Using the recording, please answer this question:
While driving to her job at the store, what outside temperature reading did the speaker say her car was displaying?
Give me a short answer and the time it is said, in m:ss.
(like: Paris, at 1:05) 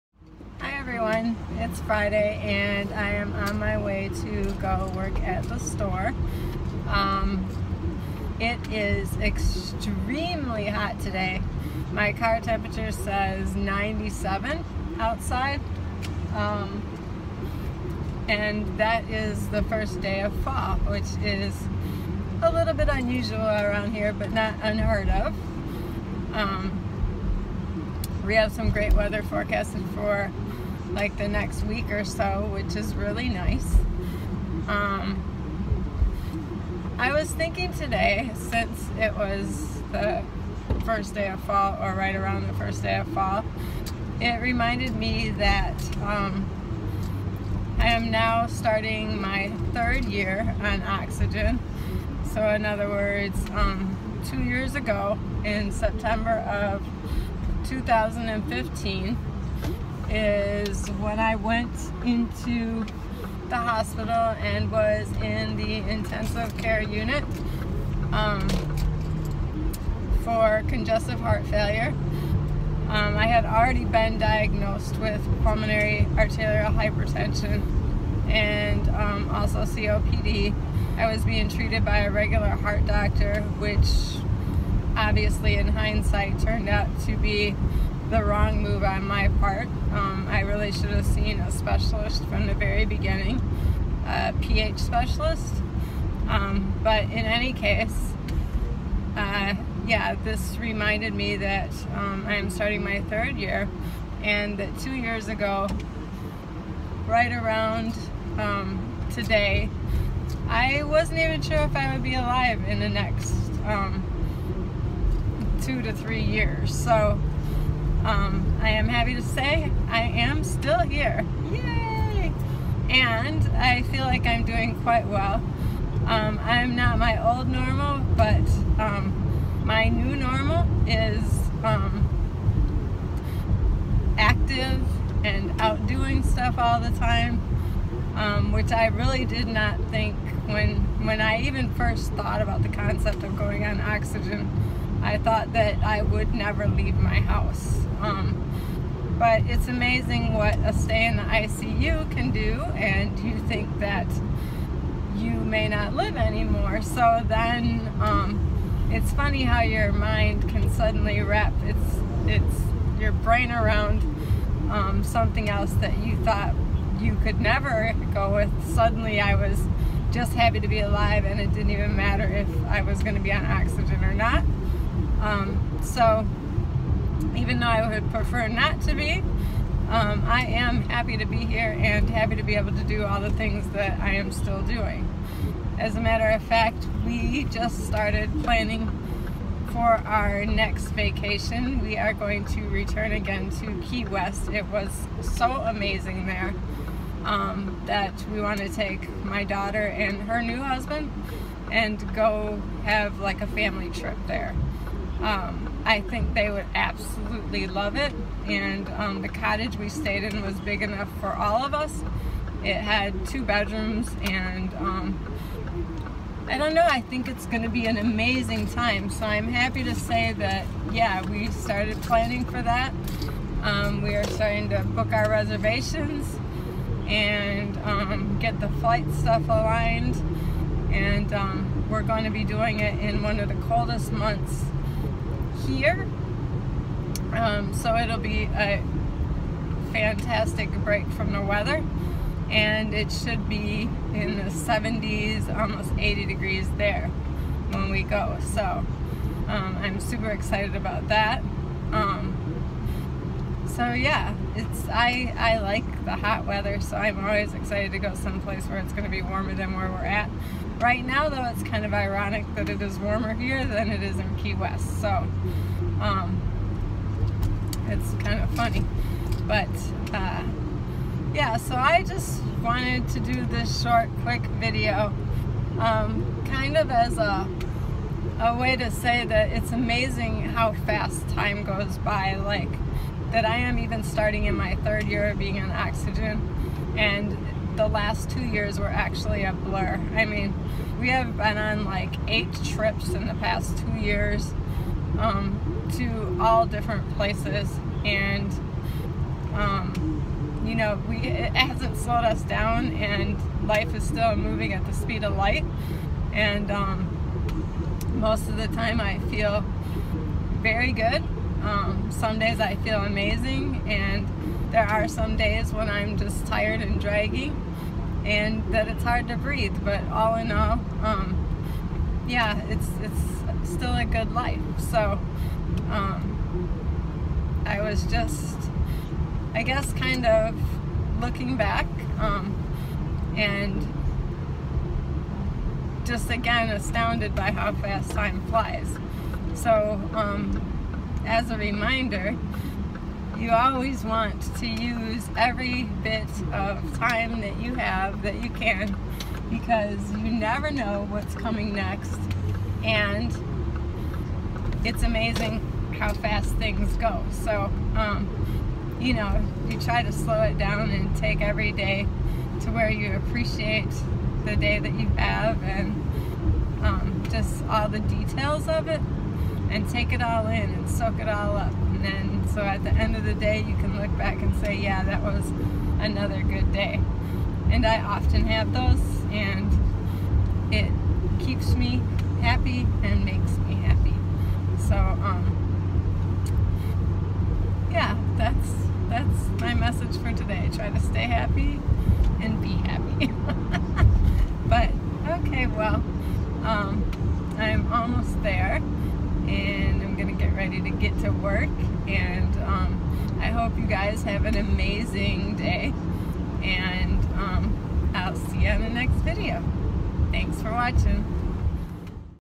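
97, at 0:13.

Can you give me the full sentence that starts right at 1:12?
Um, I had already been diagnosed with pulmonary arterial hypertension and um, also COPD.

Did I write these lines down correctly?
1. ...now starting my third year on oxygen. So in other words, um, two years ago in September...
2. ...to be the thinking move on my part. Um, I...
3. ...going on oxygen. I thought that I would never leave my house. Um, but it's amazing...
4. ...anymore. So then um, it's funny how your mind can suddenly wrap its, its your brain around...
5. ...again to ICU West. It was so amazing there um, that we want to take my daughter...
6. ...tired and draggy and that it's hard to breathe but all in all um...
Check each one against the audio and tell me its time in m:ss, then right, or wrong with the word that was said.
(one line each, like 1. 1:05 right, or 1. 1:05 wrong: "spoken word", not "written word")
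1. 0:48 right
2. 1:27 wrong: "wrong", not "thinking"
3. 2:23 right
4. 2:36 right
5. 3:13 wrong: "Key", not "ICU"
6. 5:16 right.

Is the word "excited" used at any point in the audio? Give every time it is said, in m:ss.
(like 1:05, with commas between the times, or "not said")
4:10, 4:17.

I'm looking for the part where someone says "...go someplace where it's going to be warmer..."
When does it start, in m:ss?
4:17.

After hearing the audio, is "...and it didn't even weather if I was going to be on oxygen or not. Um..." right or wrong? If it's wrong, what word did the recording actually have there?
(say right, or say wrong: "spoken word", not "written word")
wrong: "matter", not "weather".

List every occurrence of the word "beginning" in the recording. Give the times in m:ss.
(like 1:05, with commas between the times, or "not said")
1:32.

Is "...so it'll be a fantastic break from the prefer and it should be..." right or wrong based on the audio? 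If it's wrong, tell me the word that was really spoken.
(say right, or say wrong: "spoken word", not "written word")
wrong: "weather", not "prefer".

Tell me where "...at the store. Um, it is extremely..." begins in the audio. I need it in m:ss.
0:05.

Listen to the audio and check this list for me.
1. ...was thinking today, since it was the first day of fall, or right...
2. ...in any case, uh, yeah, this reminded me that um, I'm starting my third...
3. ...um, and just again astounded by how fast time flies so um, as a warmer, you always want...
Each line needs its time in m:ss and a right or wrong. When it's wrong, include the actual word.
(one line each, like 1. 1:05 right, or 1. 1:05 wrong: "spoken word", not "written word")
1. 0:37 right
2. 1:37 right
3. 5:32 wrong: "reminder", not "warmer".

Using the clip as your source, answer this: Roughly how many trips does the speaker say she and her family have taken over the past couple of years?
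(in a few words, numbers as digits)
8.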